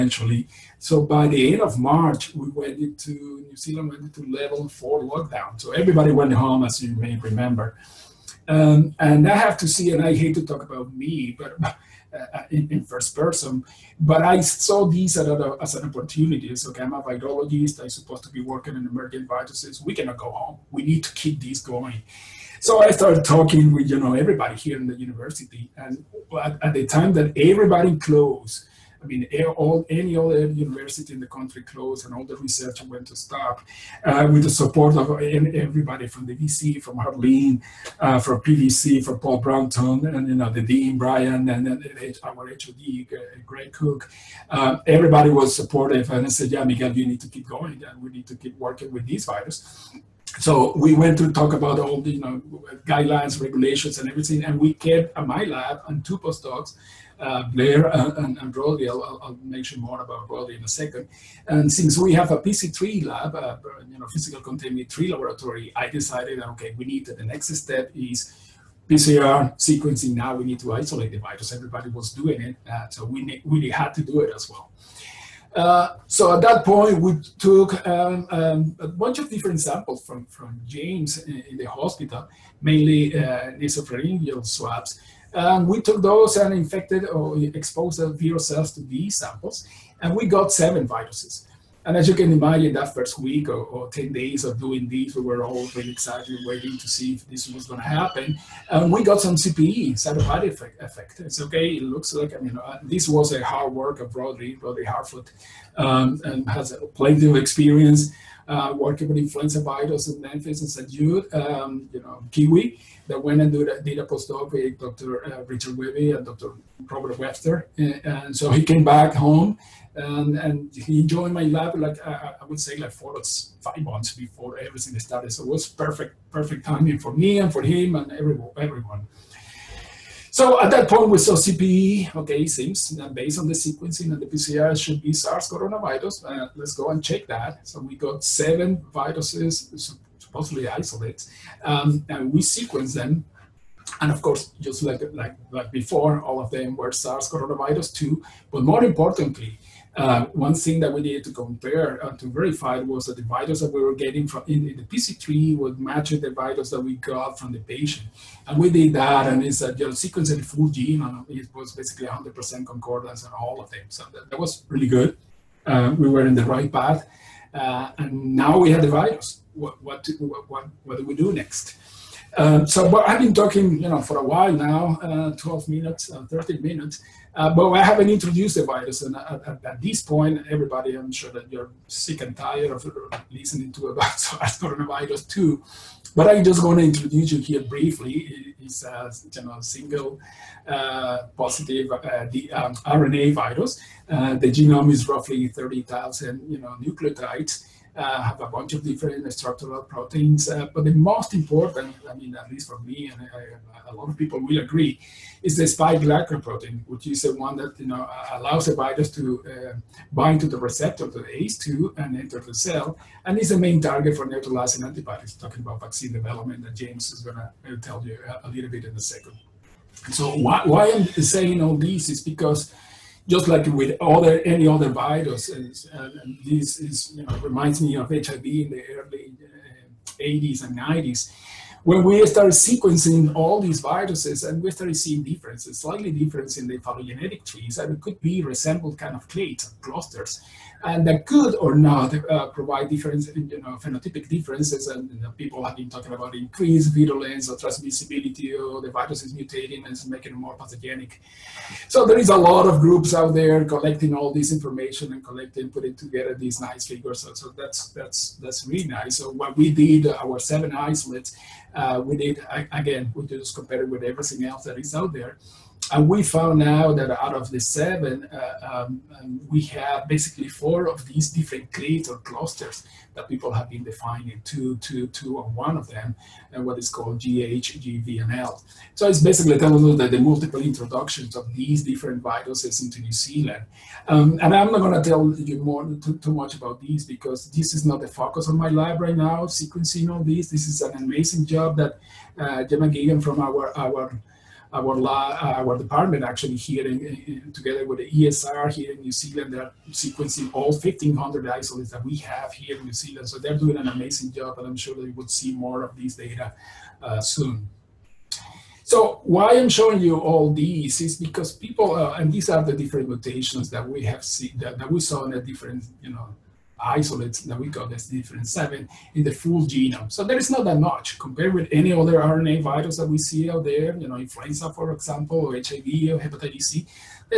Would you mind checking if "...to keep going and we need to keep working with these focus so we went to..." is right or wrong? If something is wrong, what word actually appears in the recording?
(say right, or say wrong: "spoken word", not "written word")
wrong: "virus", not "focus".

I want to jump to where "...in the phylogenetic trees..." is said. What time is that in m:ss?
3:56.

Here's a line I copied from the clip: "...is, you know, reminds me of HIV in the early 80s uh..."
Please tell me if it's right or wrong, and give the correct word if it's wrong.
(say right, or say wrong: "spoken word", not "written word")
right.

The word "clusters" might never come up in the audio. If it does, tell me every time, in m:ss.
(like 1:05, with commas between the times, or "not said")
3:59, 4:32.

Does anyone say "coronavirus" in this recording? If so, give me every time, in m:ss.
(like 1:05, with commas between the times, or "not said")
2:15, 2:27, 3:04.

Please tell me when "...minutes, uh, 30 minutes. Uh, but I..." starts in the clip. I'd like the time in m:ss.
2:55.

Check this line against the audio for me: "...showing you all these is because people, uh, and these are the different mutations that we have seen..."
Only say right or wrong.
right.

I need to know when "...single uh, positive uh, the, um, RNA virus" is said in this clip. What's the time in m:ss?
3:09.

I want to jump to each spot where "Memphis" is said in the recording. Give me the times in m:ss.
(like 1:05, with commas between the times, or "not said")
1:50.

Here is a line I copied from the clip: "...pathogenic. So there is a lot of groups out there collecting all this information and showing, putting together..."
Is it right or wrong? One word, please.
wrong.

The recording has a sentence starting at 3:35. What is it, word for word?
Talking about vaccine development, that James is going to uh, tell you a, little bit in a second.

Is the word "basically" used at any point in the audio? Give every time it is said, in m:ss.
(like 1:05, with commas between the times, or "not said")
2:41, 4:30, 4:39.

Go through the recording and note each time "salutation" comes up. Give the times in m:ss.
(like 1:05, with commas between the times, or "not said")
not said.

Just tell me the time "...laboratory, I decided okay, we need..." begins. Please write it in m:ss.
1:05.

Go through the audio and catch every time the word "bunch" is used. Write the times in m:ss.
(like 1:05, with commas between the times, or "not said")
1:18, 3:18.